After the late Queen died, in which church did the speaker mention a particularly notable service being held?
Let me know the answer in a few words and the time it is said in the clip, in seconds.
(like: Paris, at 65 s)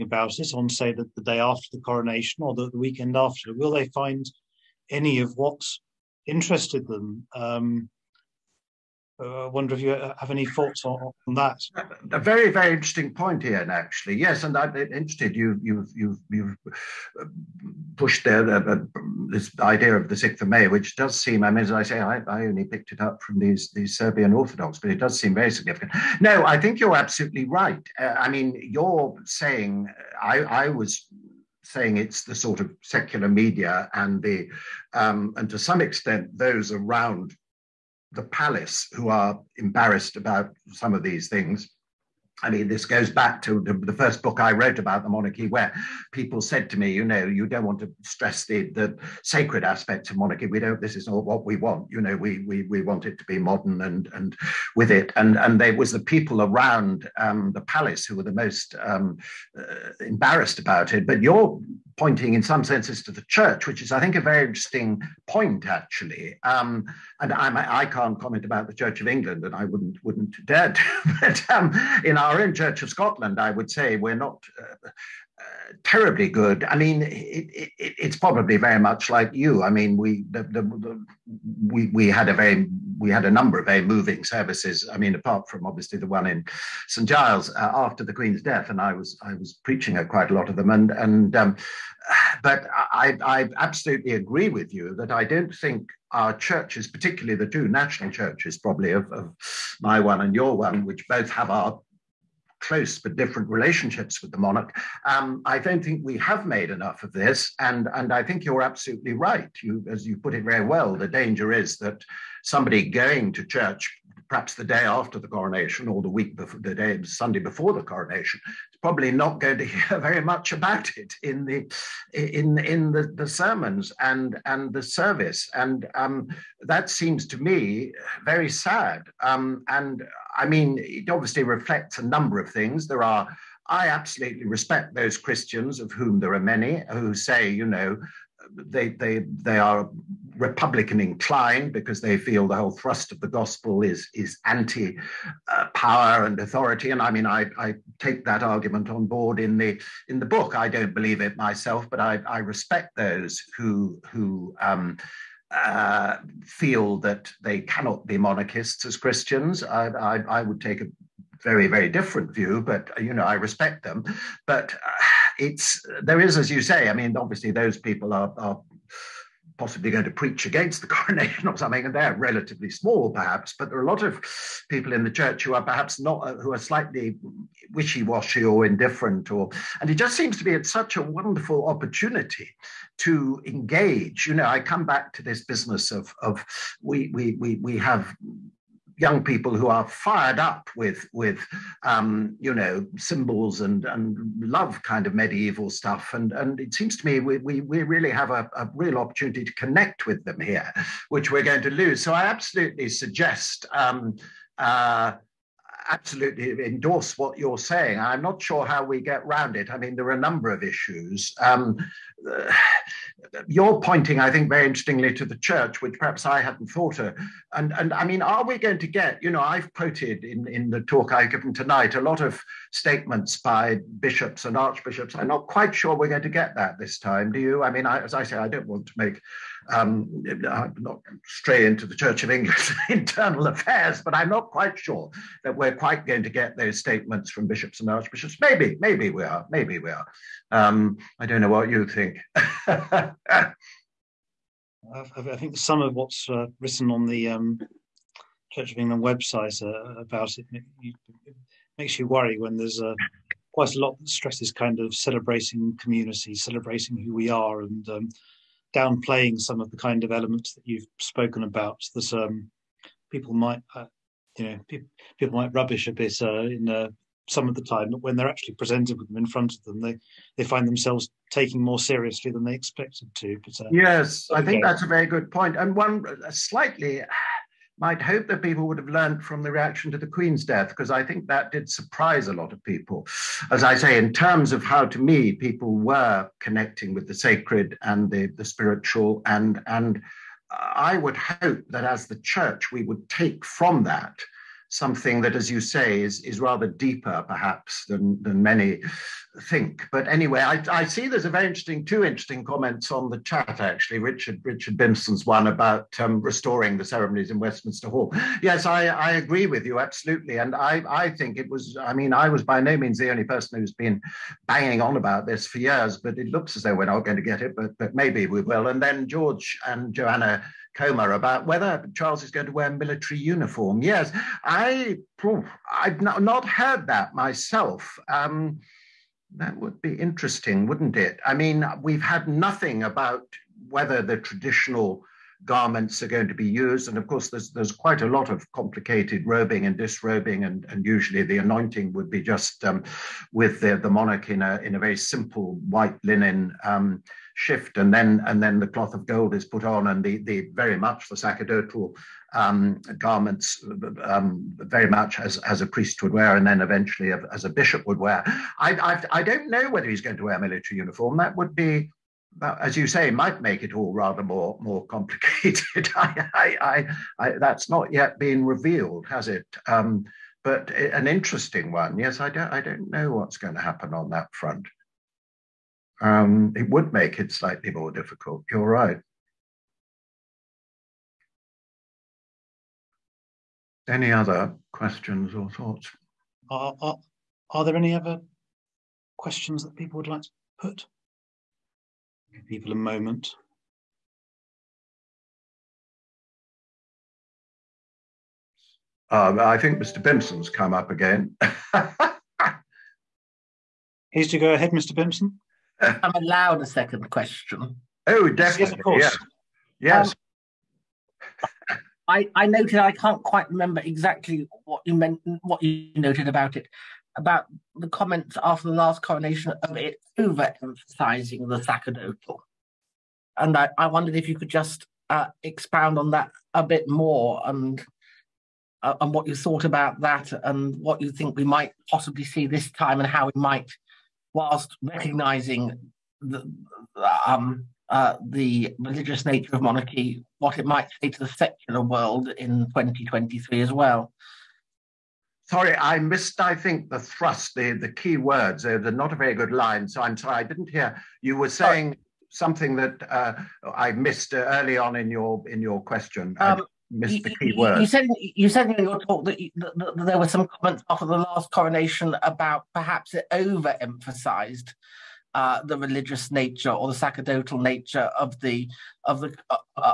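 St Giles, at 86 s.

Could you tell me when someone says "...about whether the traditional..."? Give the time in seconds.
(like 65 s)
332 s.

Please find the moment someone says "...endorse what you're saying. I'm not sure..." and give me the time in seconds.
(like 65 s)
206 s.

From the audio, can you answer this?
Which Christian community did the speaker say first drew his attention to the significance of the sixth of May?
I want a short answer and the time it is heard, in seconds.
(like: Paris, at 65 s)
Serbian Orthodox, at 23 s.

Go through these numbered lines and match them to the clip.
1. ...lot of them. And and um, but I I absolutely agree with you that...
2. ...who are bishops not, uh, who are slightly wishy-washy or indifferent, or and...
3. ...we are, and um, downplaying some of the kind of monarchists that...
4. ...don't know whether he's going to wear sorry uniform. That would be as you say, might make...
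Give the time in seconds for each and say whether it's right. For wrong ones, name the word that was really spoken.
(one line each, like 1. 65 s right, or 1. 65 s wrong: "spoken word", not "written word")
1. 90 s right
2. 175 s wrong: "perhaps", not "bishops"
3. 257 s wrong: "elements", not "monarchists"
4. 359 s wrong: "military", not "sorry".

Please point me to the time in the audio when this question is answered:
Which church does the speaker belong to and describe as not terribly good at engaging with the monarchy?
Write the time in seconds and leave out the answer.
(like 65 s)
72 s.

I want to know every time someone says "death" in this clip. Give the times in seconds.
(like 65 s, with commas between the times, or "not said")
88 s, 280 s.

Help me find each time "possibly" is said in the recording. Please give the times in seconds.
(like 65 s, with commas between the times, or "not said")
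169 s, 431 s.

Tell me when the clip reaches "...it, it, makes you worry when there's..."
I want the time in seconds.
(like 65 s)
250 s.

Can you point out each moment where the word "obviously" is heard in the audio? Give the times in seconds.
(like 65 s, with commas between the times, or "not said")
85 s, 131 s, 167 s.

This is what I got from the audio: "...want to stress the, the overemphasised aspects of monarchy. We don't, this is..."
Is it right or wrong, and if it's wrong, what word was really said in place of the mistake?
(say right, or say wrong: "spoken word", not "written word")
wrong: "sacred", not "overemphasised".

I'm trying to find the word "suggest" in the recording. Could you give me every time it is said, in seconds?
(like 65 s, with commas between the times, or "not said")
202 s.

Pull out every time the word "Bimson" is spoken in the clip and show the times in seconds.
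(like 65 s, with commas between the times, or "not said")
304 s, 400 s, 404 s.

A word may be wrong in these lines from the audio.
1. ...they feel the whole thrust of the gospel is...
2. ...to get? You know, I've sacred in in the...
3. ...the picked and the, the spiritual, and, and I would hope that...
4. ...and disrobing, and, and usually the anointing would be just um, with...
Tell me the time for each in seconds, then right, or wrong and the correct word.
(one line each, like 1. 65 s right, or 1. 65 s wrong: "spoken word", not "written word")
1. 142 s right
2. 218 s wrong: "quoted", not "sacred"
3. 287 s wrong: "sacred", not "picked"
4. 339 s right.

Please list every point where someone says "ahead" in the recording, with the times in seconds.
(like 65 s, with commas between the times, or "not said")
404 s.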